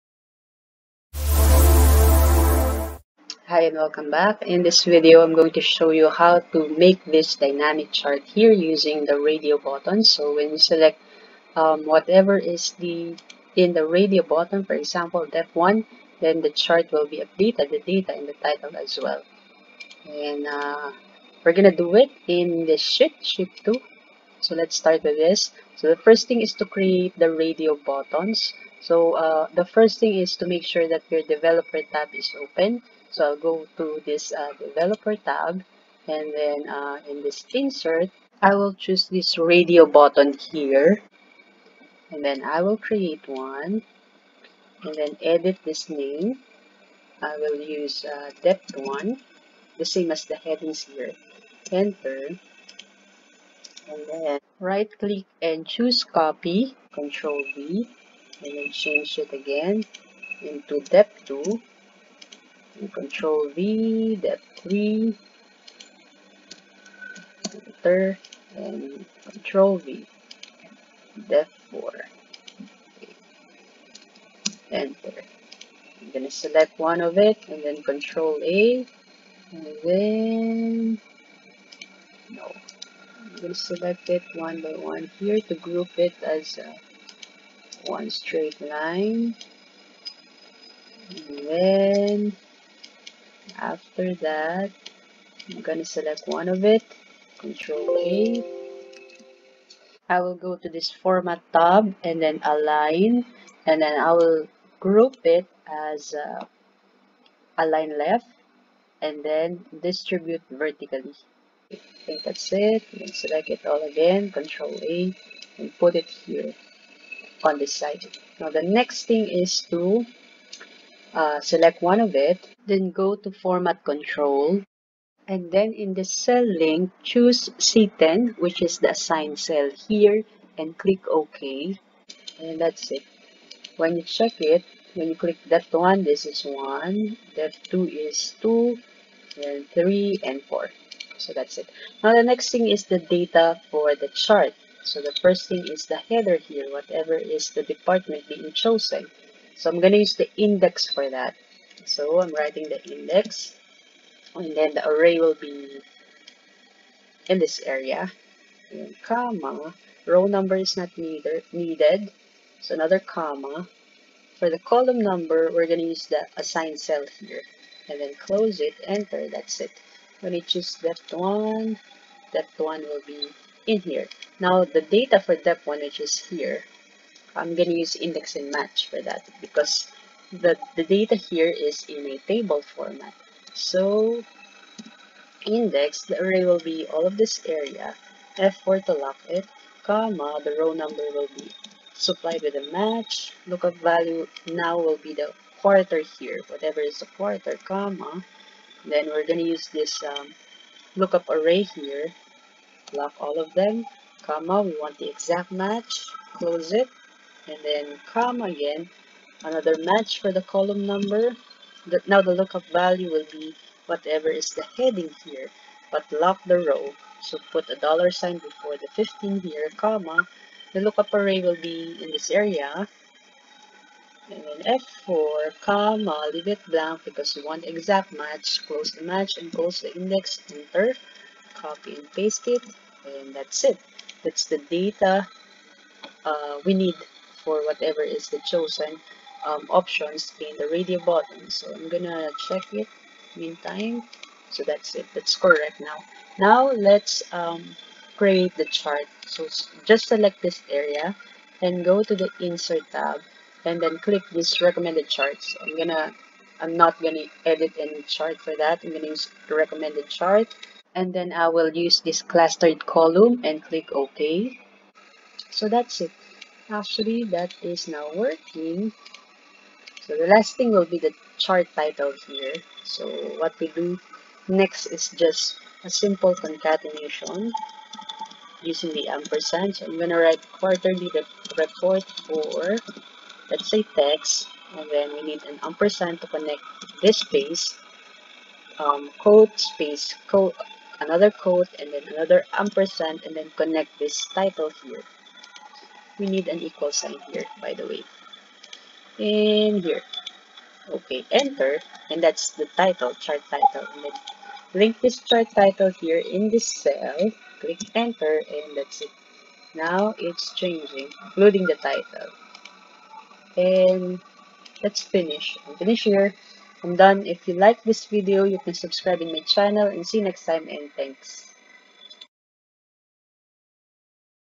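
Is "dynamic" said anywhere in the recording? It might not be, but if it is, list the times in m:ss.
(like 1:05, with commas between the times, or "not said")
0:07.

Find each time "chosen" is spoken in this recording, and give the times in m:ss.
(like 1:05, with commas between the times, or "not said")
2:28, 3:58.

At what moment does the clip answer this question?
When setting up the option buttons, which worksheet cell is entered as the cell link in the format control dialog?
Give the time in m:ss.
2:07.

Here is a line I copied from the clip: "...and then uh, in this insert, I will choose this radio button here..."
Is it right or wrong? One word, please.
right.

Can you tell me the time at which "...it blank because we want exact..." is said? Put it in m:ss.
3:46.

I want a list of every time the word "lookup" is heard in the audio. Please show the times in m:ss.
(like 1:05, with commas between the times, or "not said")
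3:13, 3:20, 3:32, 3:40.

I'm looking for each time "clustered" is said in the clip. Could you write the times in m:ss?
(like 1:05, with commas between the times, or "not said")
4:22.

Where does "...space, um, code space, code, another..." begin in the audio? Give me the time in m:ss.
4:47.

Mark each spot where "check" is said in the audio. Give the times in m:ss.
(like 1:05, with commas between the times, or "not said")
2:14, 4:02.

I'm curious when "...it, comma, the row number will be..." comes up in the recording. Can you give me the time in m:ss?
3:09.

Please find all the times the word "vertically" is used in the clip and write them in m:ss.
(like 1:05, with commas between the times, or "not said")
1:50.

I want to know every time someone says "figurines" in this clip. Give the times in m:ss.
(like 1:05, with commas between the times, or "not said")
not said.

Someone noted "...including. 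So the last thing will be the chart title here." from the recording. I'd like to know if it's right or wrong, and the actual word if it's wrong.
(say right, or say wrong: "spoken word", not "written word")
wrong: "working", not "including".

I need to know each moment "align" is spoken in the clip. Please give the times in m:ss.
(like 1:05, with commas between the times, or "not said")
1:42, 1:47.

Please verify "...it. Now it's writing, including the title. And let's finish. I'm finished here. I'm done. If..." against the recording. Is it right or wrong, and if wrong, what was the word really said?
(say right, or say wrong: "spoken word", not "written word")
wrong: "changing", not "writing".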